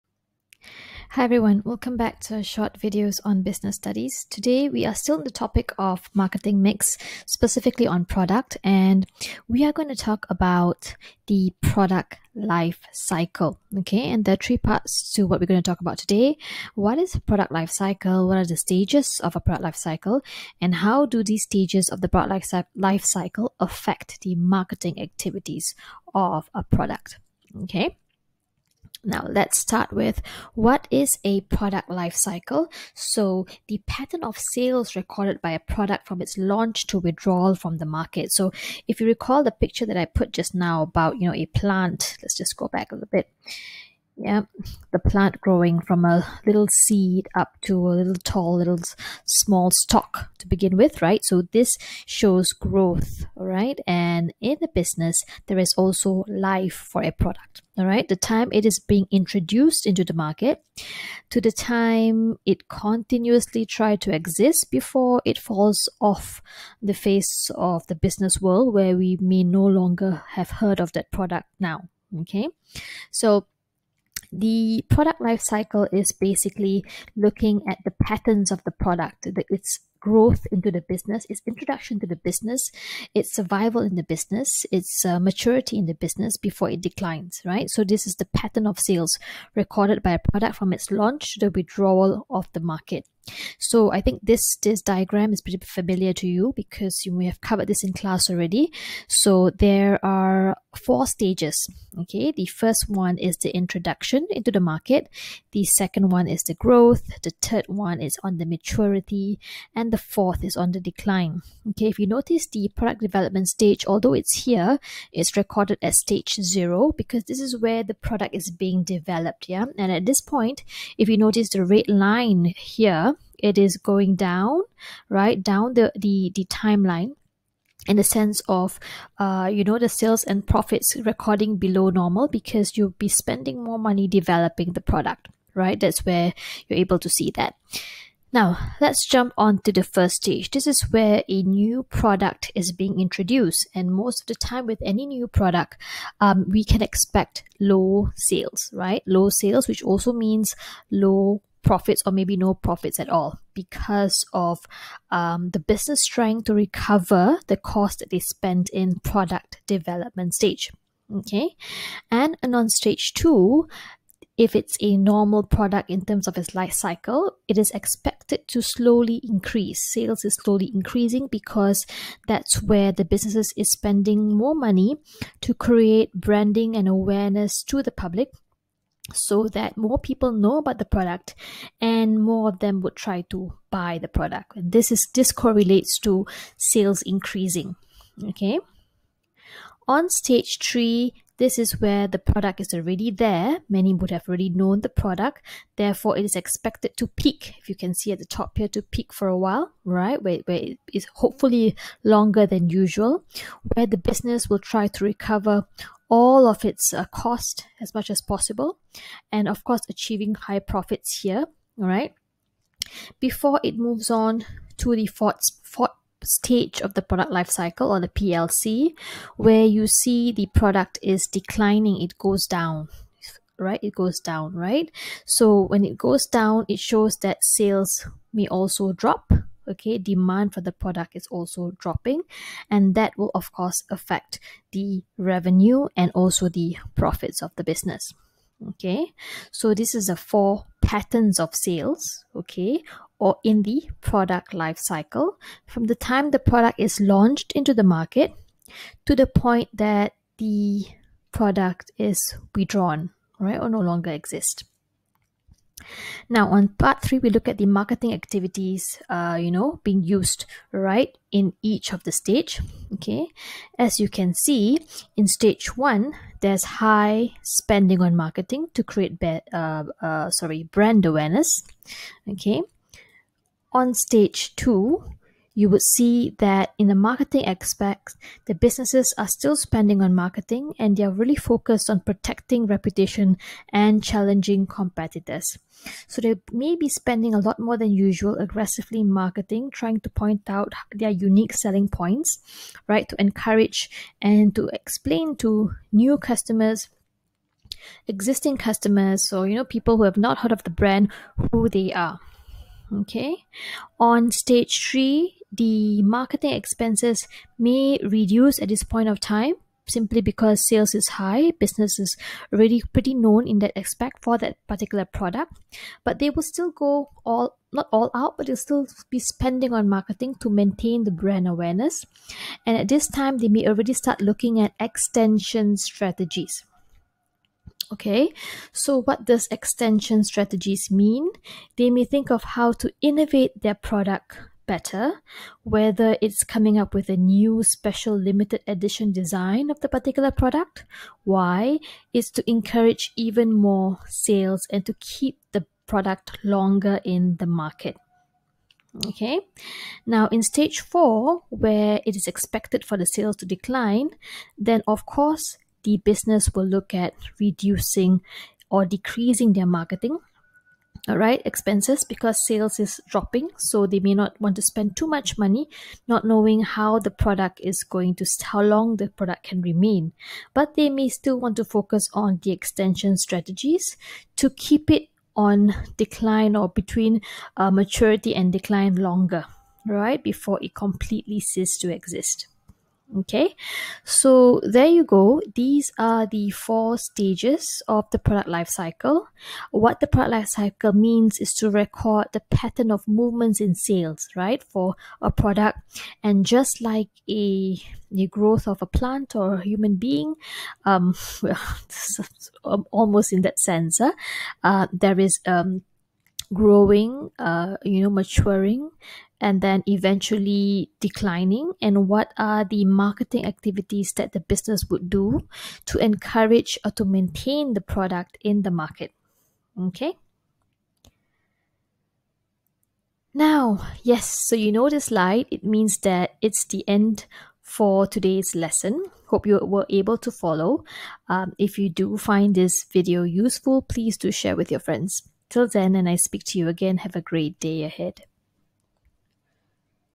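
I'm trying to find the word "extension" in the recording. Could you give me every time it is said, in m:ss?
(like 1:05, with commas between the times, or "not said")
5:24, 5:29, 6:12.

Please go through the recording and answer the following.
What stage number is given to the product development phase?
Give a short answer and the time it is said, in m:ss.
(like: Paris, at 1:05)
stage zero, at 1:55.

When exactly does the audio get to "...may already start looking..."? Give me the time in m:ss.
5:23.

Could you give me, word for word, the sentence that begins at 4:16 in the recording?
Now, on part three, we look at the marketing activities, uh, you know, being used right in each of the stage.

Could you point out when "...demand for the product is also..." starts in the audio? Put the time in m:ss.
3:49.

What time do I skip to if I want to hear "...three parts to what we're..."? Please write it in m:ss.
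0:14.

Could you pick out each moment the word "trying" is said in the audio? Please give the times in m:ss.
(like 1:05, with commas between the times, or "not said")
2:36, 4:49.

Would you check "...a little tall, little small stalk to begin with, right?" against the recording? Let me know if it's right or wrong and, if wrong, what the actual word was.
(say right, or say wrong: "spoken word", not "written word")
right.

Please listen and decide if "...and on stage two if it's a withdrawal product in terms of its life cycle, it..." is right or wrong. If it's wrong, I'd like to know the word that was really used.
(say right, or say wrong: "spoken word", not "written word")
wrong: "normal", not "withdrawal".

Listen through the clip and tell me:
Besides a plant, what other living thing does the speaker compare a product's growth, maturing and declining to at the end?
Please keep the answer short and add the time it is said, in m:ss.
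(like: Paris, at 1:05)
a human being, at 6:39.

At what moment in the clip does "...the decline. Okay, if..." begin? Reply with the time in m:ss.
1:50.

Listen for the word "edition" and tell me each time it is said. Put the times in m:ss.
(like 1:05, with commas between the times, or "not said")
5:38.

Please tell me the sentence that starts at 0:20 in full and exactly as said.
And how do these stages of the product life cycle affect the marketing activities of a product?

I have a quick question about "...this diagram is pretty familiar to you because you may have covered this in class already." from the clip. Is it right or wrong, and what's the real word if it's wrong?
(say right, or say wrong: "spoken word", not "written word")
right.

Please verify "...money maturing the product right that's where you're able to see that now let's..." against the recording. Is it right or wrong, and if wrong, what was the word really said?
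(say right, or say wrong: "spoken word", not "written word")
wrong: "developing", not "maturing".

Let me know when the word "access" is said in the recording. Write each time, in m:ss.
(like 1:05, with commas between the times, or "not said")
not said.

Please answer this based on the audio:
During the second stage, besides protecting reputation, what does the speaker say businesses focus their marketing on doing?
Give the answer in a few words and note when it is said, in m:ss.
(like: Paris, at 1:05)
challenging competitors, at 4:44.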